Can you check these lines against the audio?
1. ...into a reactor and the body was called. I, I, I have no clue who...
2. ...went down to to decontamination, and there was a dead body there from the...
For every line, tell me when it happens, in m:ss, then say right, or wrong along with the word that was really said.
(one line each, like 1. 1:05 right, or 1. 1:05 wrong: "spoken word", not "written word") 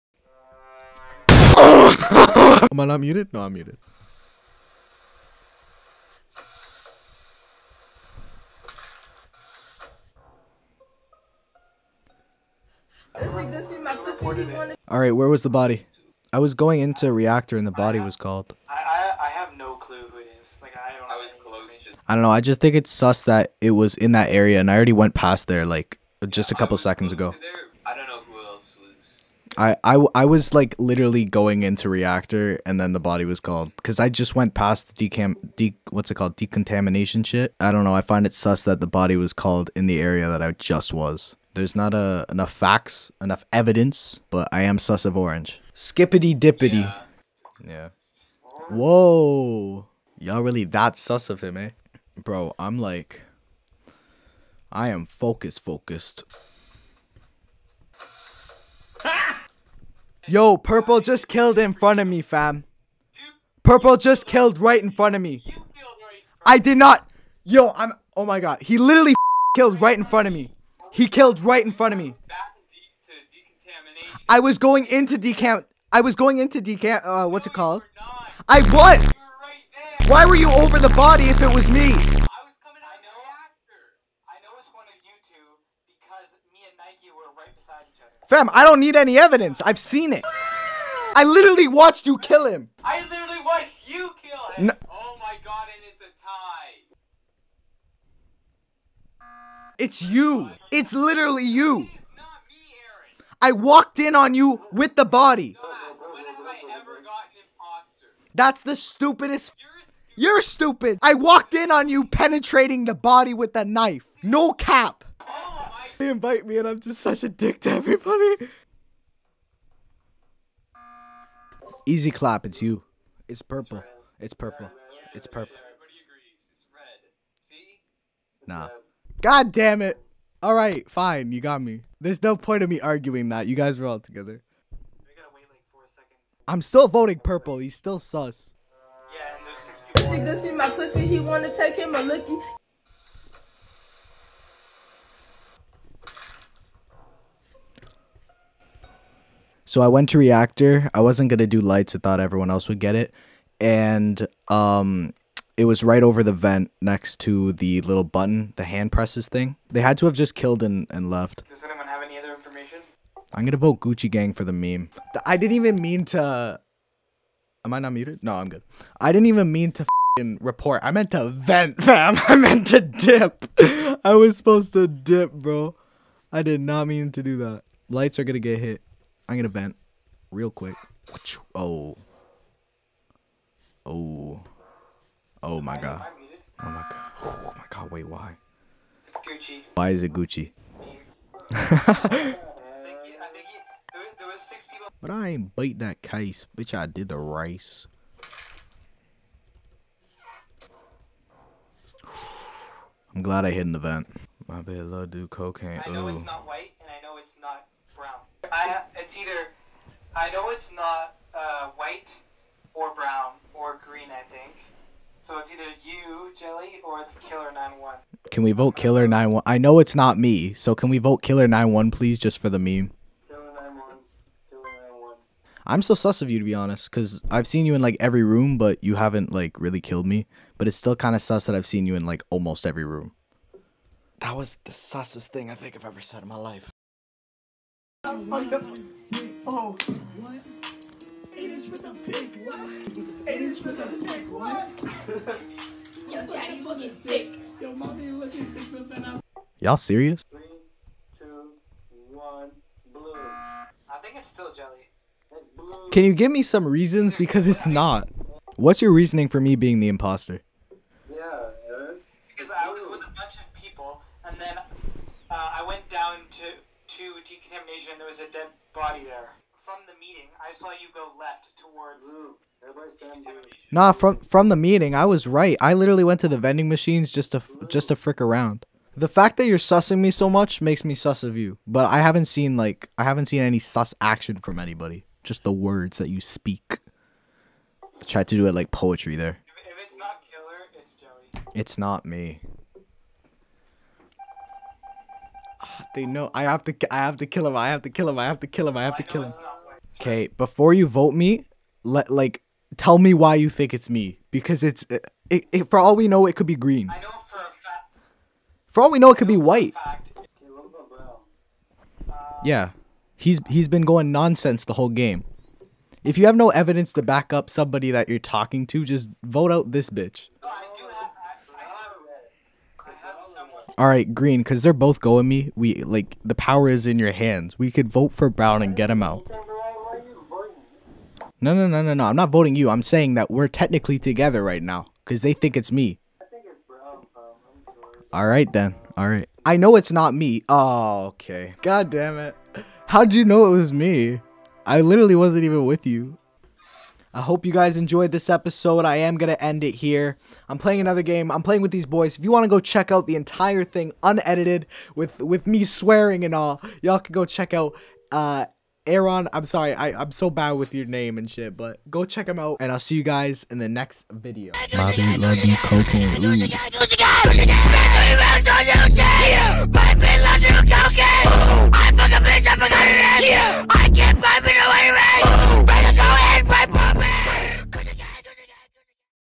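1. 0:16 right
2. 4:25 right.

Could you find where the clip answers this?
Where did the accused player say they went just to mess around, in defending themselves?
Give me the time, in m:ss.
4:36.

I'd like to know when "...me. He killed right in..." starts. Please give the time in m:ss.
1:10.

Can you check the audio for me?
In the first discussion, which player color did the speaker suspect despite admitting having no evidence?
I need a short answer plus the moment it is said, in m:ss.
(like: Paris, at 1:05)
Orange, at 0:44.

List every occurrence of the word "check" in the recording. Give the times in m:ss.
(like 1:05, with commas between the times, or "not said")
5:52, 5:57, 6:02.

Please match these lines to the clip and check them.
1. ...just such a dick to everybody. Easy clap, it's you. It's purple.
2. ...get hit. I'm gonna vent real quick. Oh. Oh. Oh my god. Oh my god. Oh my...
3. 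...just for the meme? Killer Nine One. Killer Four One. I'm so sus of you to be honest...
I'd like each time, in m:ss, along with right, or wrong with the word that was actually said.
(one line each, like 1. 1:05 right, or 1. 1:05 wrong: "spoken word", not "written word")
1. 1:56 right
2. 2:58 right
3. 3:42 wrong: "Nine", not "Four".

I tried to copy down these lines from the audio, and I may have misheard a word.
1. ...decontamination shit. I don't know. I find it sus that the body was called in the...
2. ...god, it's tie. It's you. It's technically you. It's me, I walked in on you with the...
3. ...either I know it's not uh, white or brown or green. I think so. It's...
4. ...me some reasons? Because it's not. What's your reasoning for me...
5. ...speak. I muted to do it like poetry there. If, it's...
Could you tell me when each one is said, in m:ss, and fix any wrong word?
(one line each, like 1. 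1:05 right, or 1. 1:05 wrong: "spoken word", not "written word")
1. 0:36 right
2. 1:35 wrong: "literally", not "technically"
3. 3:29 right
4. 4:16 right
5. 4:46 wrong: "tried", not "muted".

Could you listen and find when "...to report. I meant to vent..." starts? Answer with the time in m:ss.
2:49.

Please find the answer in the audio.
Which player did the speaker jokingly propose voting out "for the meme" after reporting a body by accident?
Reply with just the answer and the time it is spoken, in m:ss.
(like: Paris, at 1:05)
Gucci Gang, at 2:43.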